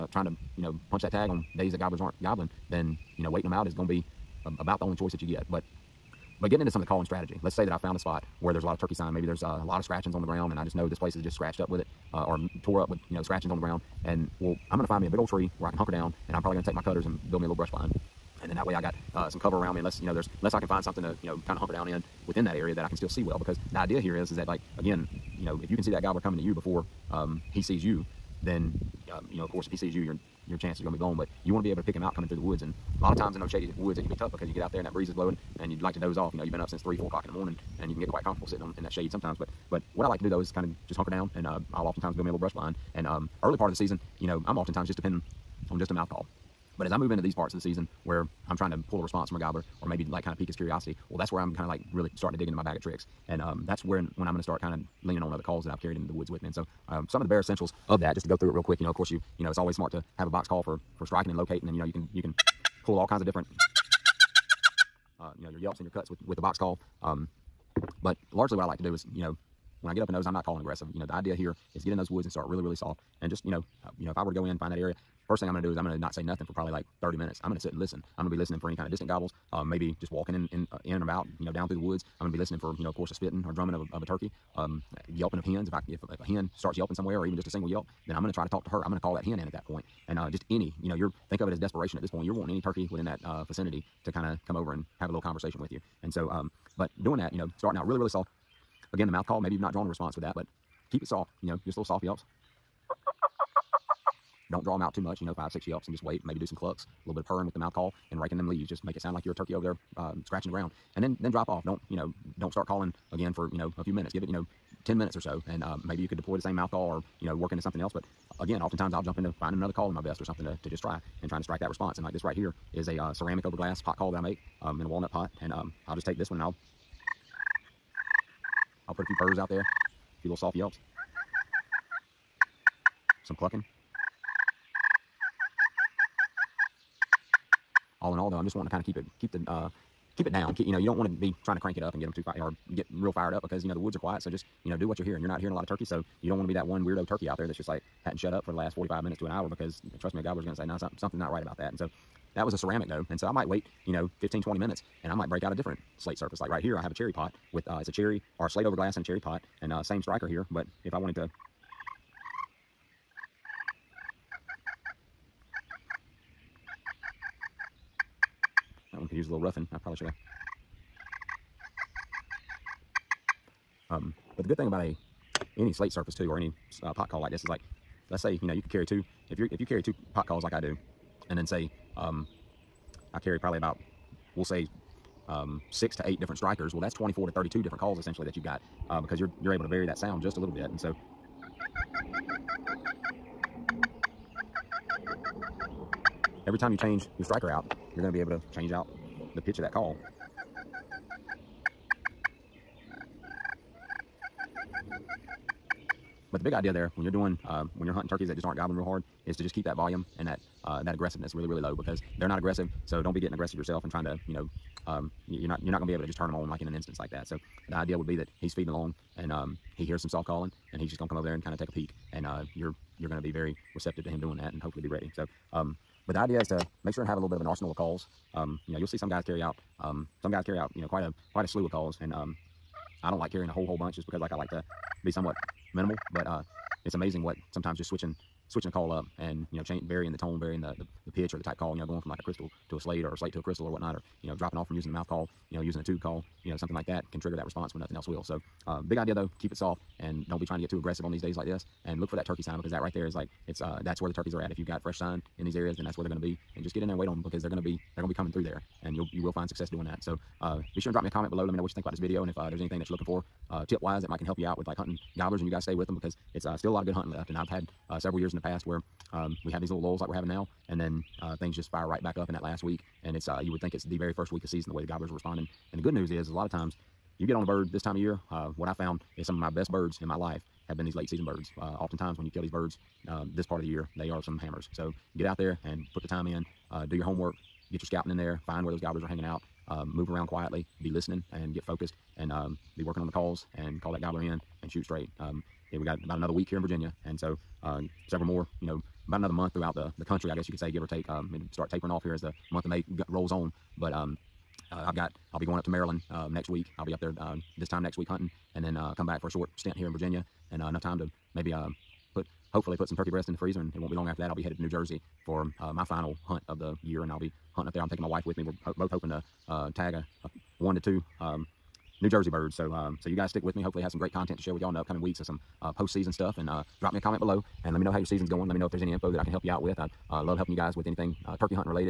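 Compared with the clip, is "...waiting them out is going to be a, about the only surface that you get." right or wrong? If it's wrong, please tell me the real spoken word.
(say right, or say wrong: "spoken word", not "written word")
wrong: "choice", not "surface".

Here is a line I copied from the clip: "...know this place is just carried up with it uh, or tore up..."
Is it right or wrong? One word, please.
wrong.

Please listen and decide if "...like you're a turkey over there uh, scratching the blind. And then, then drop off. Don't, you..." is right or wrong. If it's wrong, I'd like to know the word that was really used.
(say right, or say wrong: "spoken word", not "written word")
wrong: "ground", not "blind".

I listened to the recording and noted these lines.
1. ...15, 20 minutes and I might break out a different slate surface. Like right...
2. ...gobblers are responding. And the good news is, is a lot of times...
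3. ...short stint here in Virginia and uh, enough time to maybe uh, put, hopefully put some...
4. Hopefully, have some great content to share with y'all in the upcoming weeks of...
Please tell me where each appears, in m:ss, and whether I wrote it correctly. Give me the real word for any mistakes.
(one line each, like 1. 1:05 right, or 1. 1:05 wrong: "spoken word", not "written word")
1. 2:34 right
2. 4:34 right
3. 5:09 right
4. 5:23 right.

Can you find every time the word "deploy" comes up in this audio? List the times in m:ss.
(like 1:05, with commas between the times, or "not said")
1:56.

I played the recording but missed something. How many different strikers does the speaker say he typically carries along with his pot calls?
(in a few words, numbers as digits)
6 to 8.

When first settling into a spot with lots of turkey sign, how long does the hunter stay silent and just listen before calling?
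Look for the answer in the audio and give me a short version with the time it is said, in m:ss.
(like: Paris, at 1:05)
30 minutes, at 1:17.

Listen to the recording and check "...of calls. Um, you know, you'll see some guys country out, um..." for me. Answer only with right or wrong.
wrong.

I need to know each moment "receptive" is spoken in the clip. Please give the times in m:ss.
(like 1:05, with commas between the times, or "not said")
3:43.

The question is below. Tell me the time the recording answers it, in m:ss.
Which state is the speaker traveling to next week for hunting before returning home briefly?
5:05.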